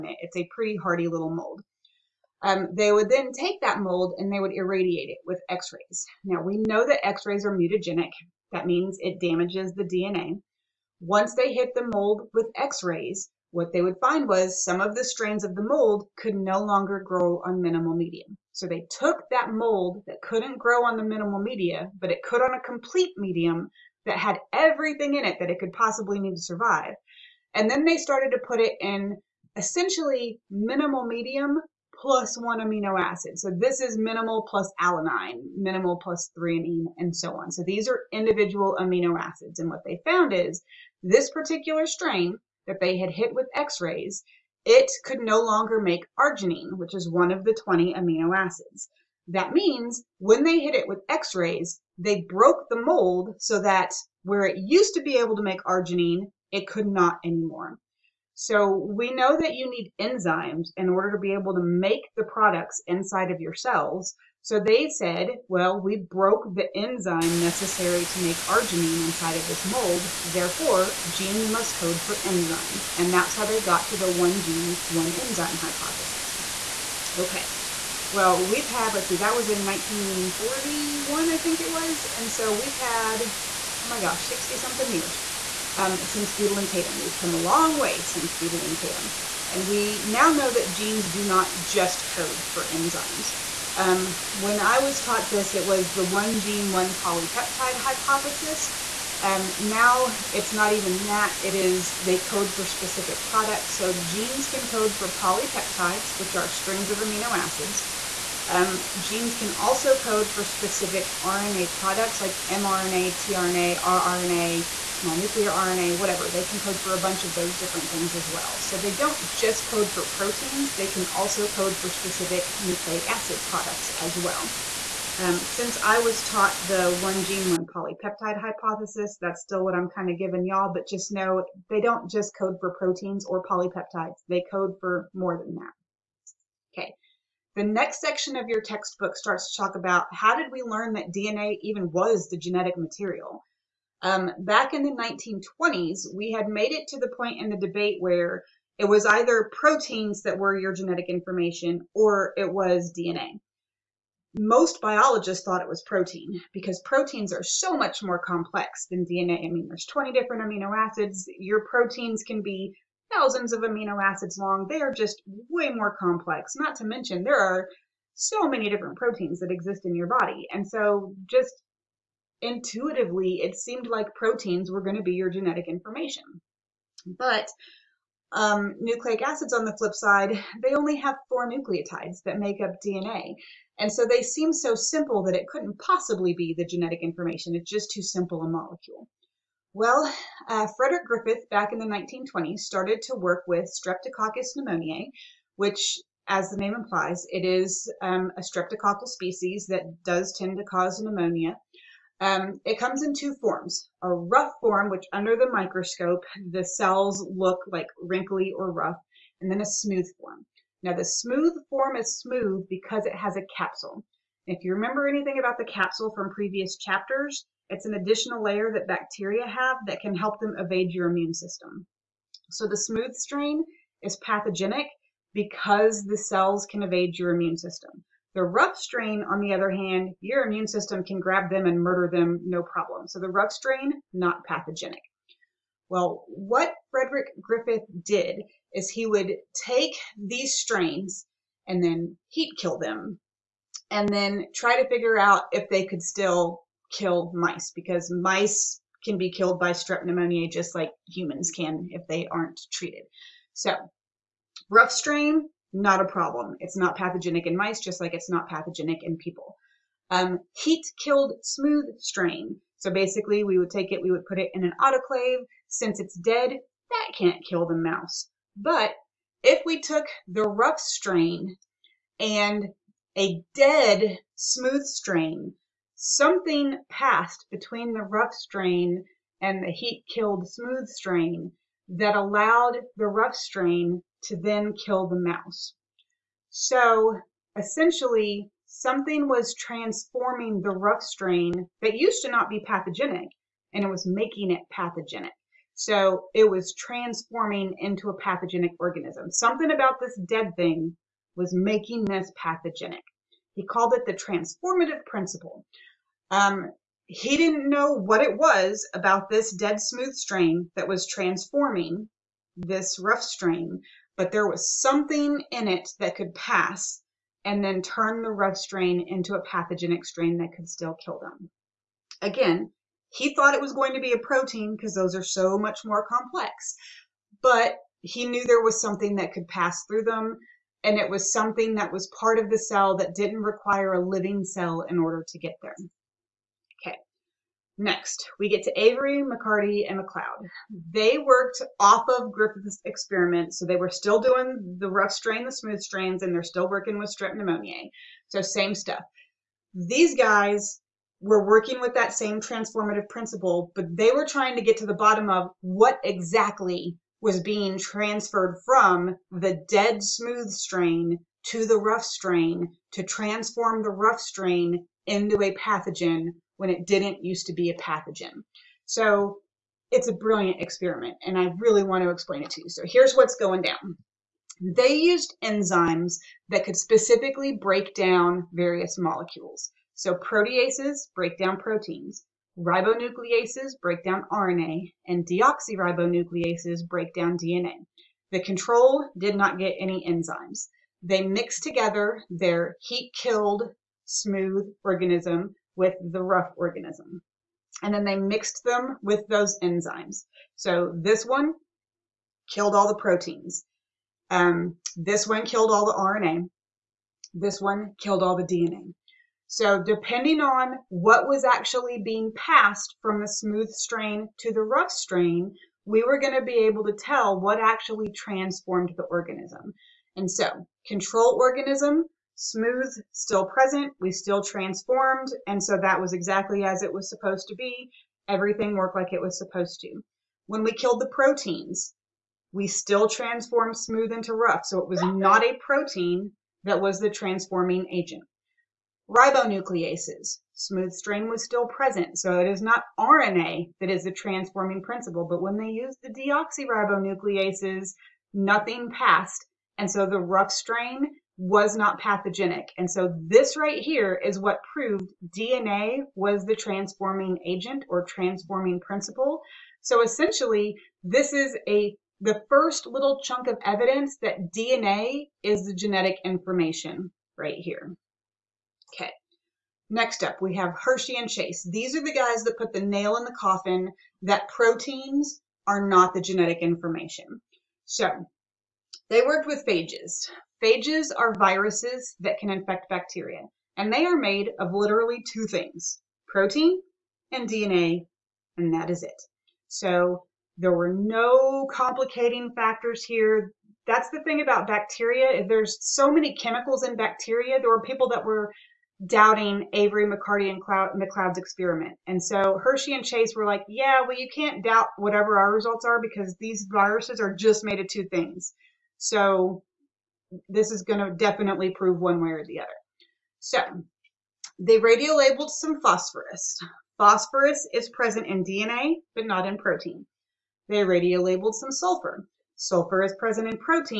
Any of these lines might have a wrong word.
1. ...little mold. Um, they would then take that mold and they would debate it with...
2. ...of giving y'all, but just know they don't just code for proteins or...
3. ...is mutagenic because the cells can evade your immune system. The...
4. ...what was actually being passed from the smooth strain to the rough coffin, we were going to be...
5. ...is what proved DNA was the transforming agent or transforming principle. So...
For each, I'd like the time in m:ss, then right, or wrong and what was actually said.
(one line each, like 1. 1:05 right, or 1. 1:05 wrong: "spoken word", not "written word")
1. 0:01 wrong: "irradiate", not "debate"
2. 2:10 right
3. 3:44 wrong: "pathogenic", not "mutagenic"
4. 6:50 wrong: "strain", not "coffin"
5. 7:34 right.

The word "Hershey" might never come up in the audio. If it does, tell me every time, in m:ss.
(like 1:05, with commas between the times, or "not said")
7:50, 8:22.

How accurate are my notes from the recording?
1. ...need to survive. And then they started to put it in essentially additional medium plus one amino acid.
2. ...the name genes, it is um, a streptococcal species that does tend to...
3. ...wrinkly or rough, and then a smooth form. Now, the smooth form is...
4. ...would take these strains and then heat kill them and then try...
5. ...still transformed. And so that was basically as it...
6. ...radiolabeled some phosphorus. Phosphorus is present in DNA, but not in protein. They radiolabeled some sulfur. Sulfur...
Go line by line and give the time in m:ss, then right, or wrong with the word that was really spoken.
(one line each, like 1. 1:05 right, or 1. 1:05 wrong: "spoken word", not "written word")
1. 0:26 wrong: "minimal", not "additional"
2. 3:16 wrong: "implies", not "genes"
3. 3:28 right
4. 3:59 right
5. 7:04 wrong: "exactly", not "basically"
6. 8:34 right.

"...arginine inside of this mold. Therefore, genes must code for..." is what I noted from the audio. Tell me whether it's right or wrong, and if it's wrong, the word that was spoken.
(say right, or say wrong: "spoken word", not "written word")
right.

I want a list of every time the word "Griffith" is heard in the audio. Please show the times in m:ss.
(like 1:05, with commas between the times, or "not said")
3:11, 3:57, 5:42.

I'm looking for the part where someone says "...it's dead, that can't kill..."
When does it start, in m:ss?
4:25.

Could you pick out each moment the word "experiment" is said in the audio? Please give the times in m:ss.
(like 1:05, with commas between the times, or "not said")
5:42, 6:10, 8:21.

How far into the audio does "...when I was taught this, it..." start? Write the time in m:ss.
1:34.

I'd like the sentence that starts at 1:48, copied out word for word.
Um, genes can also code for specific RNA products like mRNA, tRNA, rRNA, small nuclear RNA, whatever.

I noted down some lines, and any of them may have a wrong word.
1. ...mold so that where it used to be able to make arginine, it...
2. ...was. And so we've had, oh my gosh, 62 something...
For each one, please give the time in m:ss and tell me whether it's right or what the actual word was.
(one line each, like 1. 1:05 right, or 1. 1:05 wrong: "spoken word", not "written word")
1. 0:52 right
2. 1:21 wrong: "60", not "62".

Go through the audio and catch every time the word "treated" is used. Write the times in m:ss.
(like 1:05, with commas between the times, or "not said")
4:12.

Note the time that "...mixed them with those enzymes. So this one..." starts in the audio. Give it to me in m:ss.
6:38.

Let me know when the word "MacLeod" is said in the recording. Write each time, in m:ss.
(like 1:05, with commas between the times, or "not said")
5:39, 8:20.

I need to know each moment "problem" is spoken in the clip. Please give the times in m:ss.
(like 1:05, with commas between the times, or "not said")
3:52, 4:16.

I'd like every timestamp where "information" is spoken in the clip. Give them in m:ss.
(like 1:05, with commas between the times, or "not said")
2:31, 2:55, 3:07, 7:46, 7:56.